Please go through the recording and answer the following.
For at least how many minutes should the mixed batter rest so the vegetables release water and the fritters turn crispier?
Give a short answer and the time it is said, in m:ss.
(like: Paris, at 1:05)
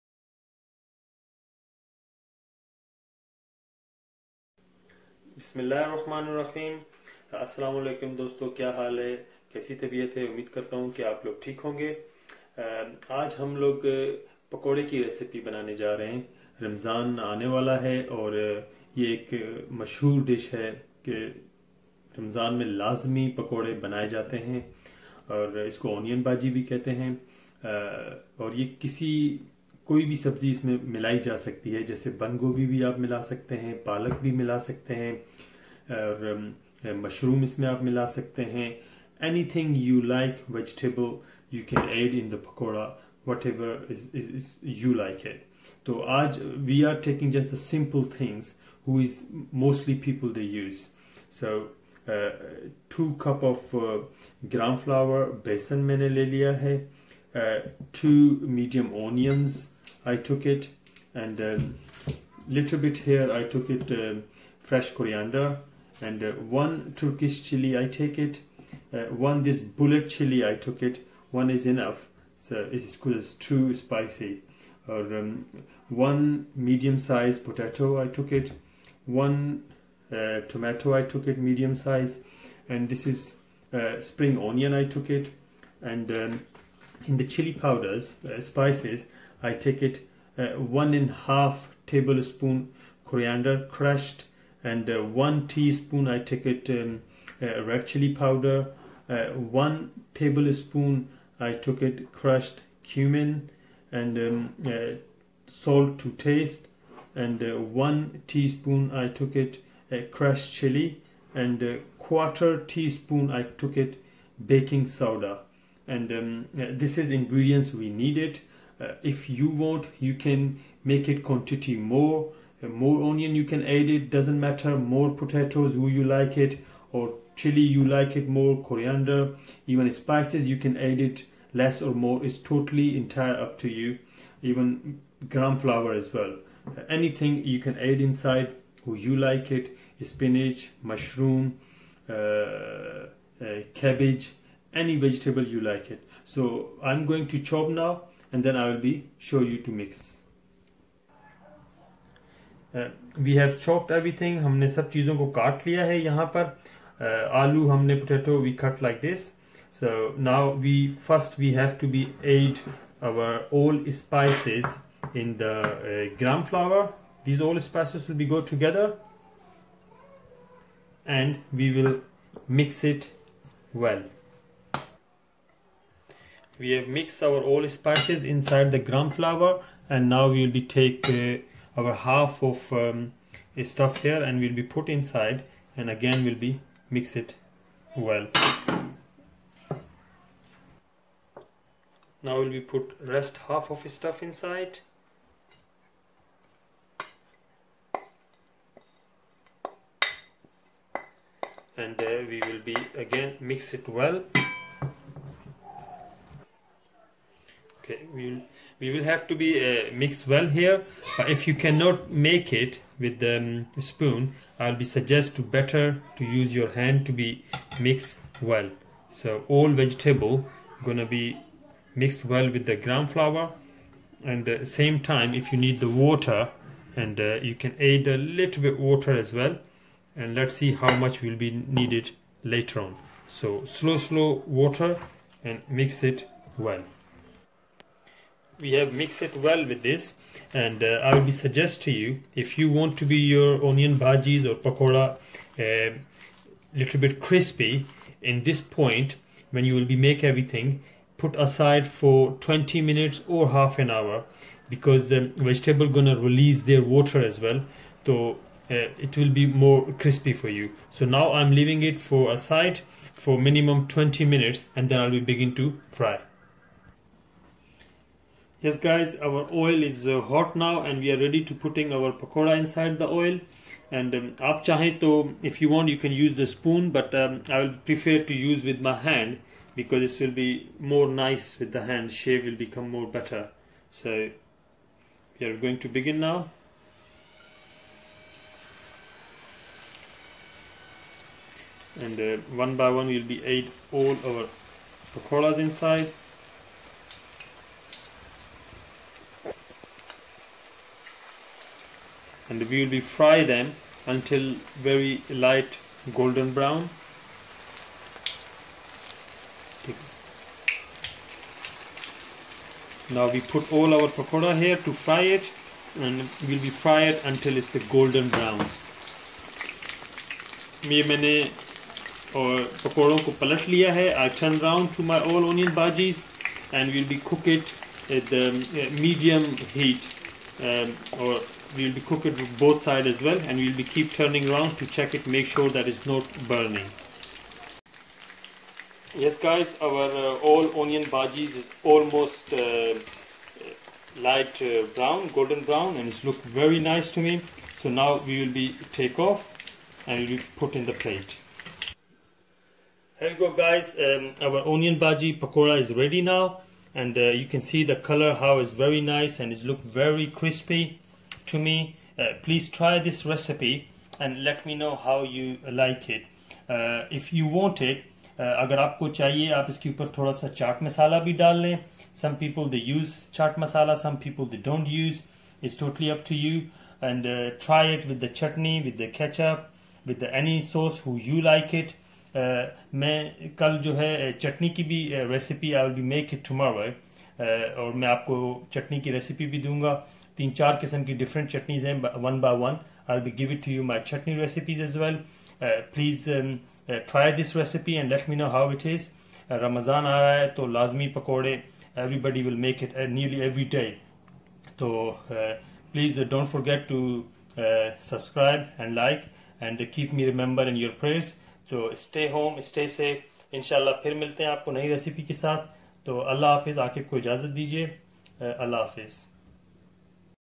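20 minutes, at 4:23.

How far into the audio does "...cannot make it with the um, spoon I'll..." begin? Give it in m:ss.
3:31.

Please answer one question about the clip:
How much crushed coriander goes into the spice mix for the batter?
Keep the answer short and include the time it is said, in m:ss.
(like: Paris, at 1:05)
1.5 tablespoons, at 1:30.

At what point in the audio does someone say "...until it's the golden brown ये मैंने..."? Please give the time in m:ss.
5:17.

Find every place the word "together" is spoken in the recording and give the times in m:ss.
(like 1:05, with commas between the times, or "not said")
2:48.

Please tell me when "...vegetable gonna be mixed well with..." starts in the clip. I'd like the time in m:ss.
3:39.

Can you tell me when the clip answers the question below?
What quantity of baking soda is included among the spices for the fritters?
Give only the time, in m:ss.
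1:51.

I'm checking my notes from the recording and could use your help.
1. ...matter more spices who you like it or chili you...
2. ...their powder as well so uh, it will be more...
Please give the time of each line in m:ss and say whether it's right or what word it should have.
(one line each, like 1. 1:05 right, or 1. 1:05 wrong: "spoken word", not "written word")
1. 2:04 wrong: "potatoes", not "spices"
2. 4:16 wrong: "water", not "powder".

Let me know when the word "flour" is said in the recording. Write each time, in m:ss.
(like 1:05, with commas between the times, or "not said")
2:15, 2:46, 2:59, 3:43.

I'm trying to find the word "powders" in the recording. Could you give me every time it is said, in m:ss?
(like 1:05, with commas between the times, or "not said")
1:27, 1:38.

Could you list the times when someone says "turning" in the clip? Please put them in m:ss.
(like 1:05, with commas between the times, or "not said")
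5:34.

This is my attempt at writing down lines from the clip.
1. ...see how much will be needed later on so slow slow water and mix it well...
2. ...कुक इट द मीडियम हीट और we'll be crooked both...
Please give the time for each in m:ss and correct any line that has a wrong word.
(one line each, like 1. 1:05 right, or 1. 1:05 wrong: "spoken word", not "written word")
1. 3:50 right
2. 5:27 right.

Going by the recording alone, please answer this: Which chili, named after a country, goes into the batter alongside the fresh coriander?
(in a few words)
Turkish chili.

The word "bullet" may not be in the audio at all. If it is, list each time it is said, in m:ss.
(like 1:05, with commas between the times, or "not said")
1:09.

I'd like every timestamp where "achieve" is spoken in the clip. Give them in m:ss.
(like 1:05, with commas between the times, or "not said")
not said.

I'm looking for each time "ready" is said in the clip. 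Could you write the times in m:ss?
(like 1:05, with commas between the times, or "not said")
4:31, 5:55.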